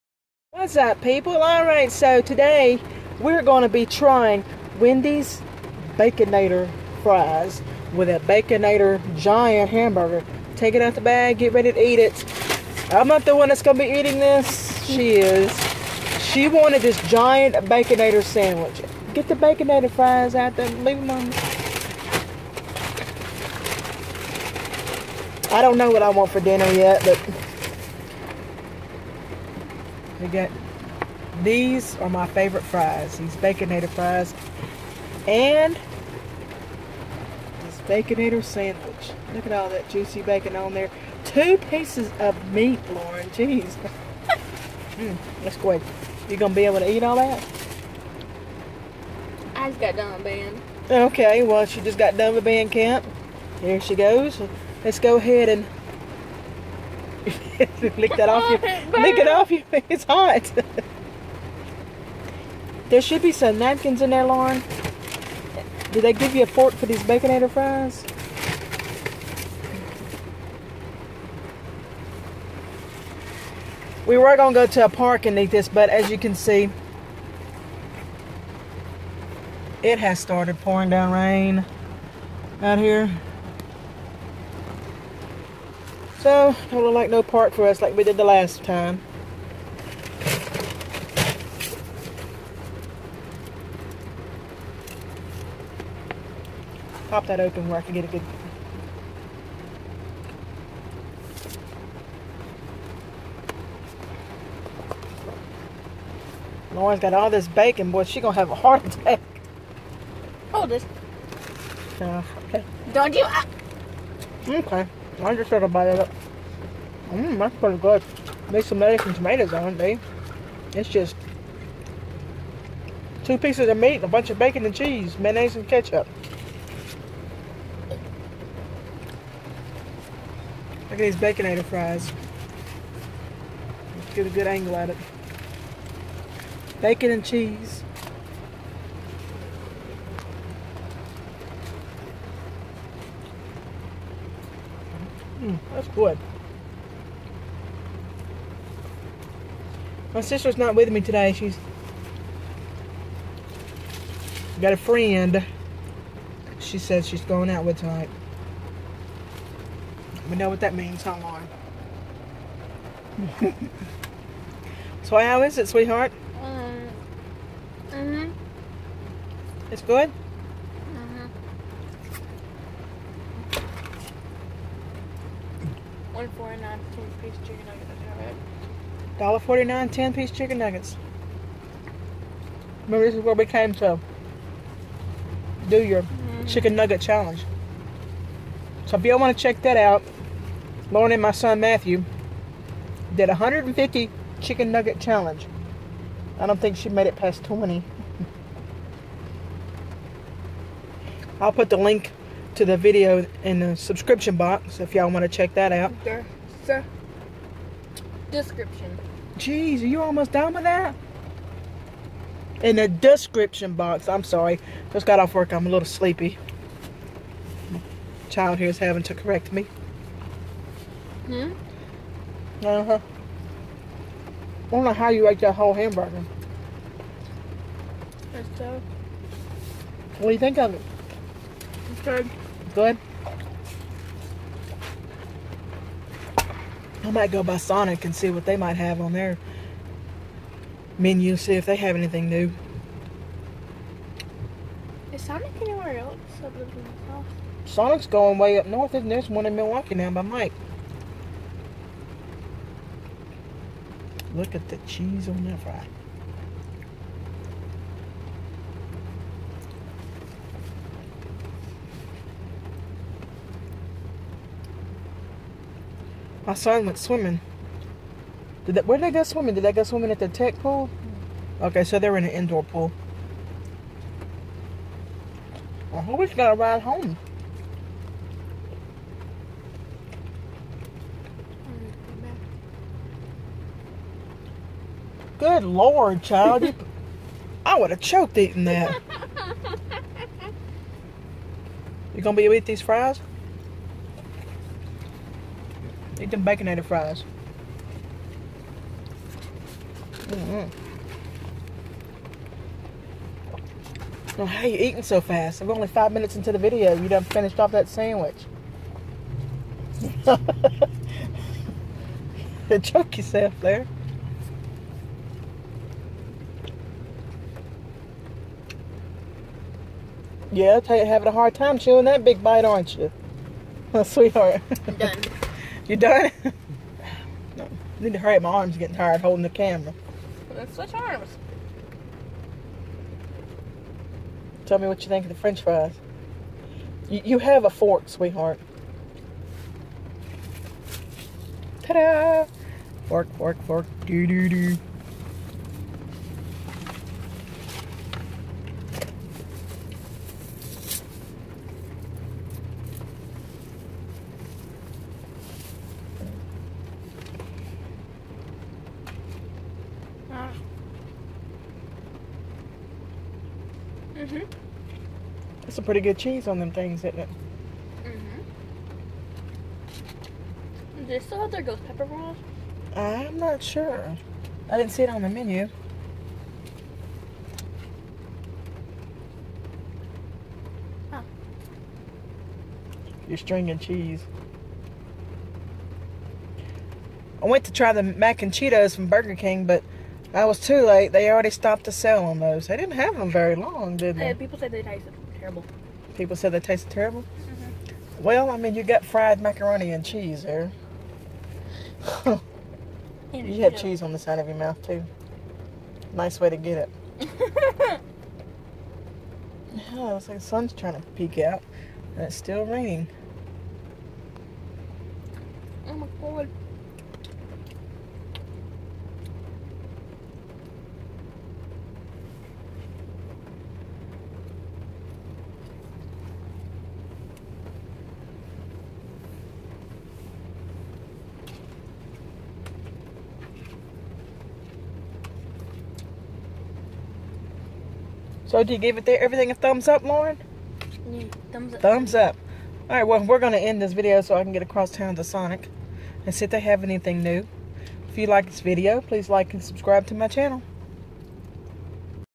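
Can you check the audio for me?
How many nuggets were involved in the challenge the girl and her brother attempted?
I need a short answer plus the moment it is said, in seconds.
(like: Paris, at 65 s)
150, at 193 s.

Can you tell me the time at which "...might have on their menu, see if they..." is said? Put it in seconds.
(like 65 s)
238 s.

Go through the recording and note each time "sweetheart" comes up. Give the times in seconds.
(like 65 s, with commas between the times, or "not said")
165 s, 324 s, 338 s.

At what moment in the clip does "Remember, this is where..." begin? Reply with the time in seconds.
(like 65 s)
182 s.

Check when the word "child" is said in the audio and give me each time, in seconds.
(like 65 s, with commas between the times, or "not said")
218 s, 286 s.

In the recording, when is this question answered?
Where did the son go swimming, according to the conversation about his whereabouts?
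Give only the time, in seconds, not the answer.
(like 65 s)
270 s.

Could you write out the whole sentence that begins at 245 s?
Is Sonic anywhere else other than Sonic's going way up north, and there's one in Milwaukee now by Mike.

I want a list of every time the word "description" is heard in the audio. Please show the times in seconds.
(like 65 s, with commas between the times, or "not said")
208 s, 212 s.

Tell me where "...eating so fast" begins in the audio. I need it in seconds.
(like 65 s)
304 s.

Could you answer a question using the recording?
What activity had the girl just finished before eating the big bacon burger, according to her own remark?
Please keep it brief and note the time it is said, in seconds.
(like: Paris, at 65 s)
Band camp, at 52 s.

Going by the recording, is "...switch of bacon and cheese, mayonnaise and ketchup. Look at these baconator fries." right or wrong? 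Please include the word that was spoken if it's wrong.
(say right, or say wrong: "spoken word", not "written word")
wrong: "bunch", not "switch".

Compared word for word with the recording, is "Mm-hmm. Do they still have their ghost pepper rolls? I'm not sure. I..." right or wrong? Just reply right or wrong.
right.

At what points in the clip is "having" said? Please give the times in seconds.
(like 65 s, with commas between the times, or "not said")
218 s, 321 s.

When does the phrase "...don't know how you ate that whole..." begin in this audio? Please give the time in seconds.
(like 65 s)
224 s.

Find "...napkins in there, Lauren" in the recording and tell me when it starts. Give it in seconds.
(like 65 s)
63 s.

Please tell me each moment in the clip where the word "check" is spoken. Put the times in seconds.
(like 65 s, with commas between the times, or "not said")
189 s, 205 s.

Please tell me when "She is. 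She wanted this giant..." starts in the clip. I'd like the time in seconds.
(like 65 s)
14 s.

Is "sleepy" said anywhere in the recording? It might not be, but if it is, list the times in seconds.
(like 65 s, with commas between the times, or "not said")
215 s.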